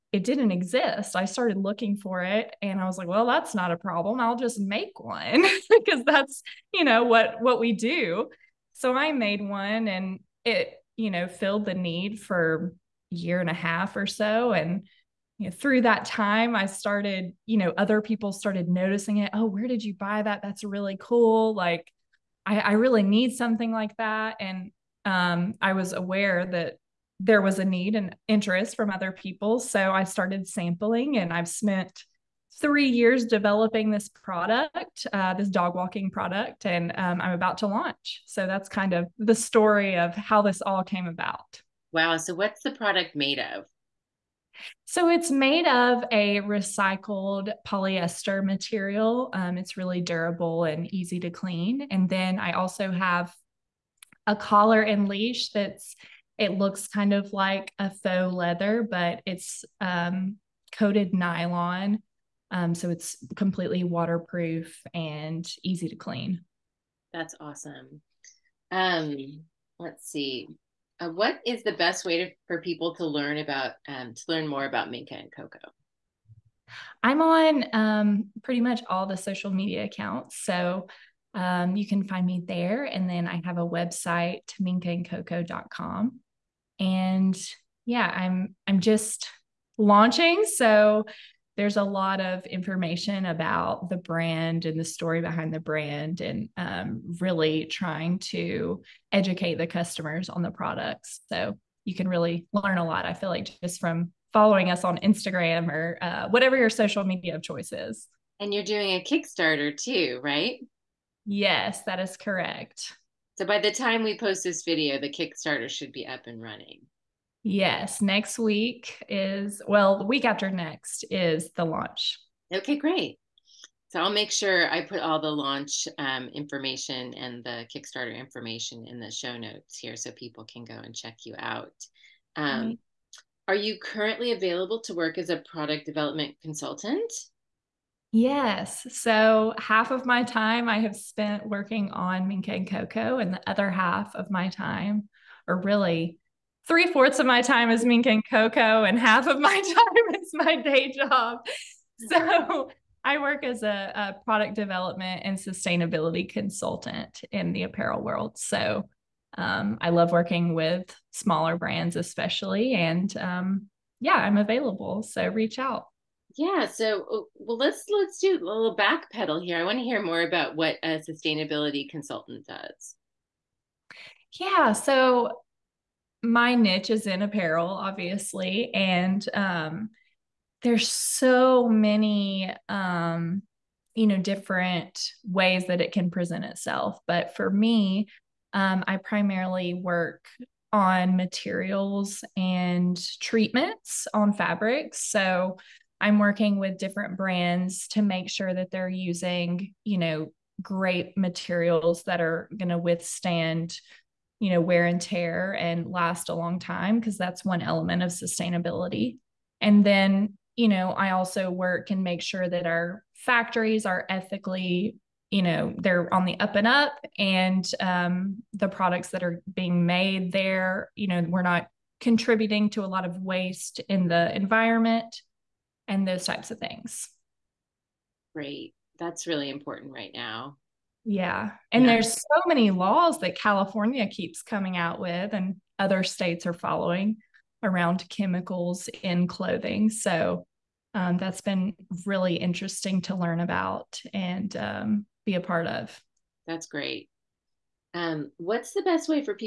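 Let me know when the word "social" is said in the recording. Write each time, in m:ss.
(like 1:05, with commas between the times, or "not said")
1:19, 1:46.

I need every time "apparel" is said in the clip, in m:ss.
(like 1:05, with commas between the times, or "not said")
2:37, 2:57.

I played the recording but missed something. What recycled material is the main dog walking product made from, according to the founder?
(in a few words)
Recycled polyester.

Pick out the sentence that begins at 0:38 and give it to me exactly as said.
So that's kind of the story of how this all came about.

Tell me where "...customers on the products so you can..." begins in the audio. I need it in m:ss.
1:39.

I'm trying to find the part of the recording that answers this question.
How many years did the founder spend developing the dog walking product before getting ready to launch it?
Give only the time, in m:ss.
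0:32.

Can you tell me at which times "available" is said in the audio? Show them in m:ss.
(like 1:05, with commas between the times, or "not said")
2:14, 2:44.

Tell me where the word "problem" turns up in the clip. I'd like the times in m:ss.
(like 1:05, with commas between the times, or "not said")
0:03.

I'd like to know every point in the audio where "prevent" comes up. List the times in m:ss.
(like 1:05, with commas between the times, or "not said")
not said.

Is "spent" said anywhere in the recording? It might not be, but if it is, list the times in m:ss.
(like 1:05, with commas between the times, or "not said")
0:31, 2:20.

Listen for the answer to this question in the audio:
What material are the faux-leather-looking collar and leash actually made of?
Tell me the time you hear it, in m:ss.
1:00.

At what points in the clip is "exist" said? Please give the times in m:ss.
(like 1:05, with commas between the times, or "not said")
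0:00.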